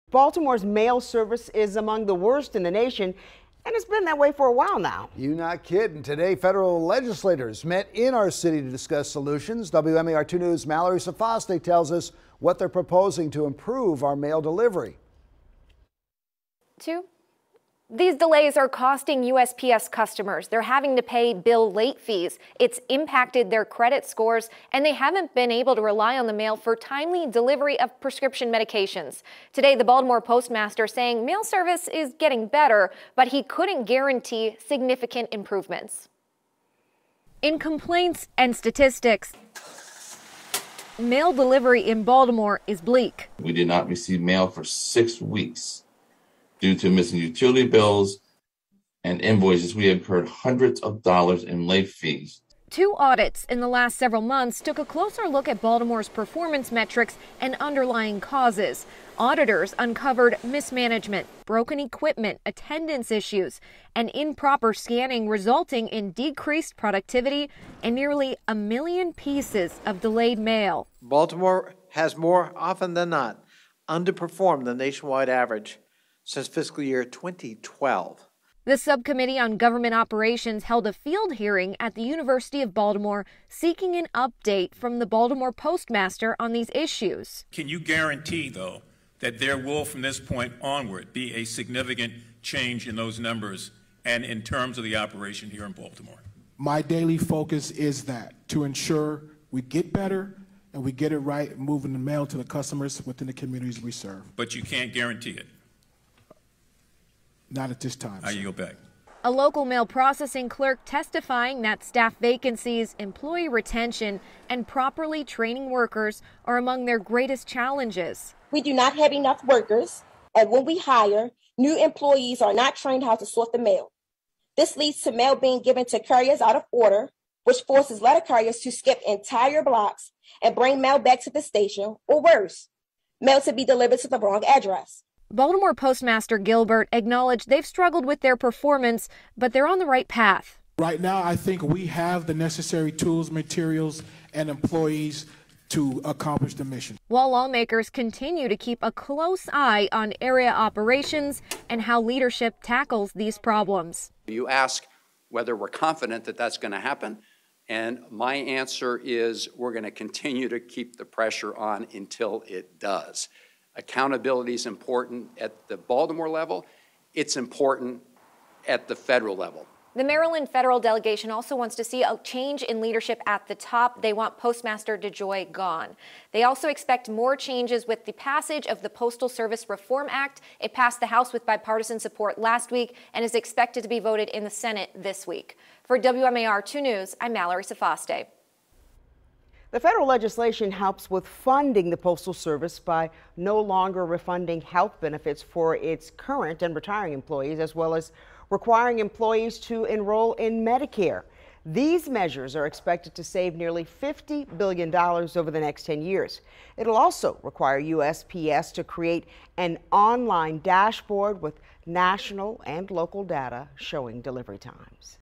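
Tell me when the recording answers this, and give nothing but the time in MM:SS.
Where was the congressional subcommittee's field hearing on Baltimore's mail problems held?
01:22.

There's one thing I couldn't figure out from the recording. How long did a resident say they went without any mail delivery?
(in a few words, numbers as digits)
6 weeks.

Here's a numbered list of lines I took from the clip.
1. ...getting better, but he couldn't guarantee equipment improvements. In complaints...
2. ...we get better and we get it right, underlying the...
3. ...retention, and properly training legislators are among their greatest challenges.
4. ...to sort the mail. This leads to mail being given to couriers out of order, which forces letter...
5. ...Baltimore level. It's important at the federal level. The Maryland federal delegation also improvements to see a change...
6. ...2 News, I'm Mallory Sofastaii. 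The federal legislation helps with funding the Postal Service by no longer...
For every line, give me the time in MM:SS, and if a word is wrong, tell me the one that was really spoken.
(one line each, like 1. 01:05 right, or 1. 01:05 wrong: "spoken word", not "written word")
1. 00:32 wrong: "significant", not "equipment"
2. 01:39 wrong: "moving", not "underlying"
3. 01:53 wrong: "workers", not "legislators"
4. 02:03 right
5. 02:45 wrong: "wants", not "improvements"
6. 03:06 right.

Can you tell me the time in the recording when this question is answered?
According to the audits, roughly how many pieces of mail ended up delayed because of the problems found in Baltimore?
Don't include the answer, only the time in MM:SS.
01:07.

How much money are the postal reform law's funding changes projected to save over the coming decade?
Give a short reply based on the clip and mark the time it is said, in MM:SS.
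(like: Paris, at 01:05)
nearly $50 billion, at 03:23.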